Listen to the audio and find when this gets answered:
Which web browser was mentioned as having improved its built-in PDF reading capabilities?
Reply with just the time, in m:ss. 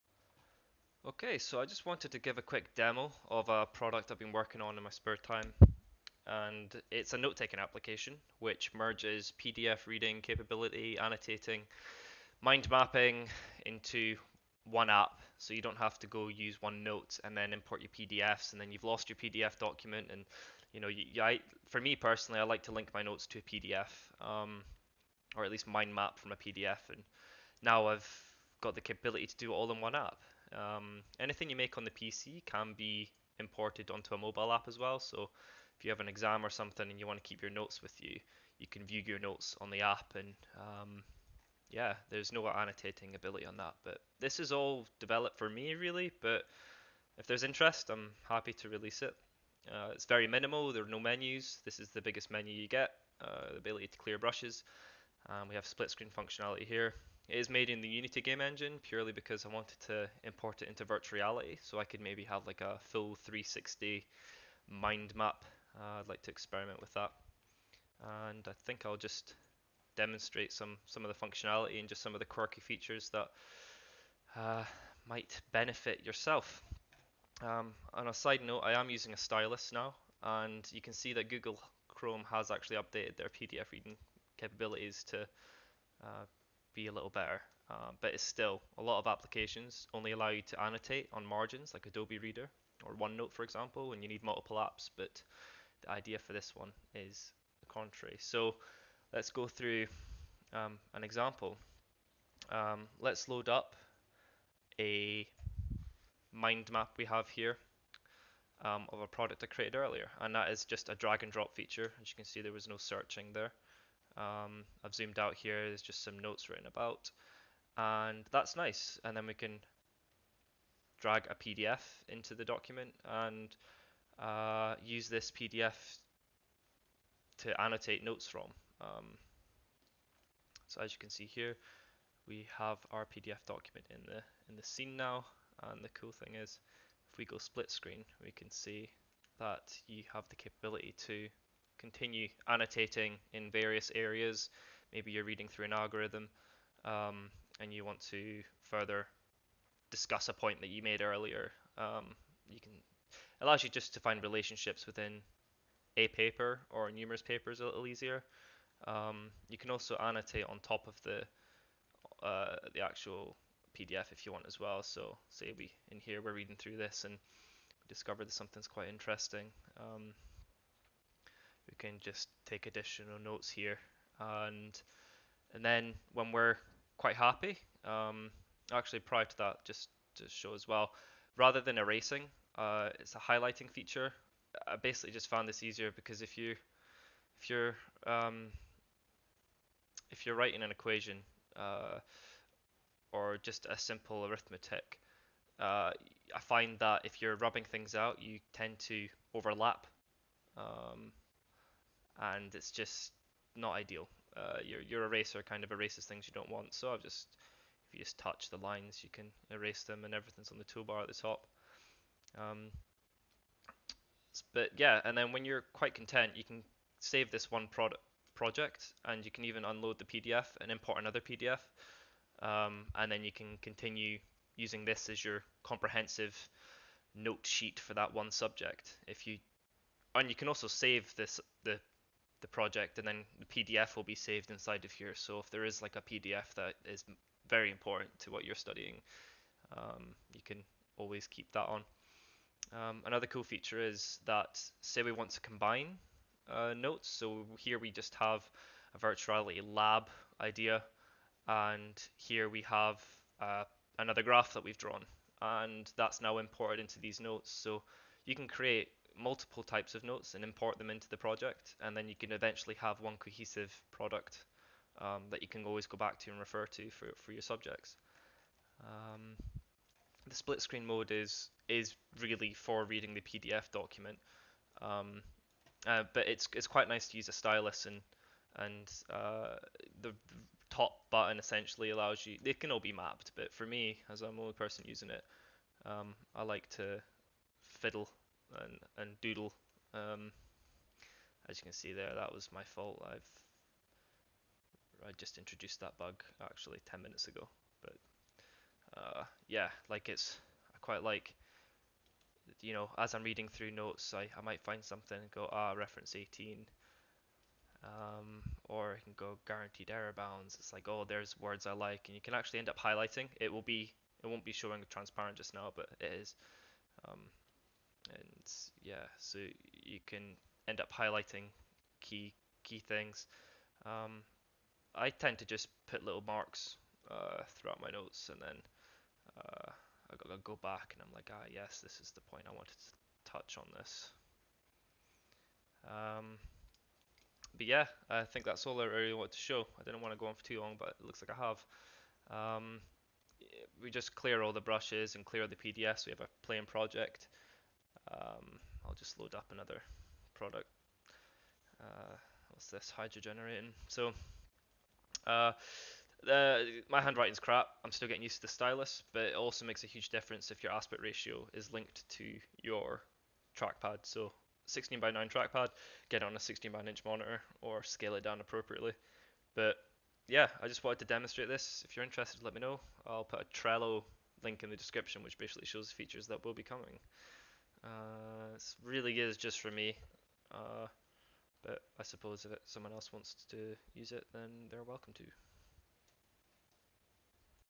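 1:21.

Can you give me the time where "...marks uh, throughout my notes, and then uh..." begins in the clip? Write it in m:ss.
5:26.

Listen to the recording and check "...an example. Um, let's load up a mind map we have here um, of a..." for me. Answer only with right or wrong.
right.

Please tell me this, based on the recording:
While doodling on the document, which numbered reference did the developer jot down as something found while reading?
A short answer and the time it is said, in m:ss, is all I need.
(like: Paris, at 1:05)
reference 18, at 5:05.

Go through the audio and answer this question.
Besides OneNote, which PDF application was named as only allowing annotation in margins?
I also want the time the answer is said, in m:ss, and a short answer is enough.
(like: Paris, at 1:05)
Adobe Reader, at 1:31.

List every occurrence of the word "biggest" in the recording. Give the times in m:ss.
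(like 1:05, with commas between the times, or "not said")
0:52.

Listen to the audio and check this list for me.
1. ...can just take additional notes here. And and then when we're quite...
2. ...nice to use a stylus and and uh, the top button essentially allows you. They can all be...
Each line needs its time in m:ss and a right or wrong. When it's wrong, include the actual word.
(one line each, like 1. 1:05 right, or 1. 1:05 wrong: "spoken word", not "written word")
1. 2:51 right
2. 4:36 right.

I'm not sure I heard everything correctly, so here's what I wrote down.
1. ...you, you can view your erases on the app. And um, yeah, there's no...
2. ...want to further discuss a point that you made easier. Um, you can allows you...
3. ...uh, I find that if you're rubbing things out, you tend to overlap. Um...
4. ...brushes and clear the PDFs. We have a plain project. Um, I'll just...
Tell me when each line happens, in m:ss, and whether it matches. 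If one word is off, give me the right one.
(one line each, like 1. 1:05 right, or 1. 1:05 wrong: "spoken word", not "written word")
1. 0:38 wrong: "notes", not "erases"
2. 2:27 wrong: "earlier", not "easier"
3. 3:15 right
4. 5:44 right.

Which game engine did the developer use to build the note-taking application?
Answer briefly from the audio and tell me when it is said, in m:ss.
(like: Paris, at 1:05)
Unity, at 0:57.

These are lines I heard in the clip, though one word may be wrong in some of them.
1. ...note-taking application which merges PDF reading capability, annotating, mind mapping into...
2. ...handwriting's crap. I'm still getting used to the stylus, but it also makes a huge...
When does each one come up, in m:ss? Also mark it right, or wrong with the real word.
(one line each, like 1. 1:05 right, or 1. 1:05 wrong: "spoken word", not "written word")
1. 0:07 right
2. 5:57 right.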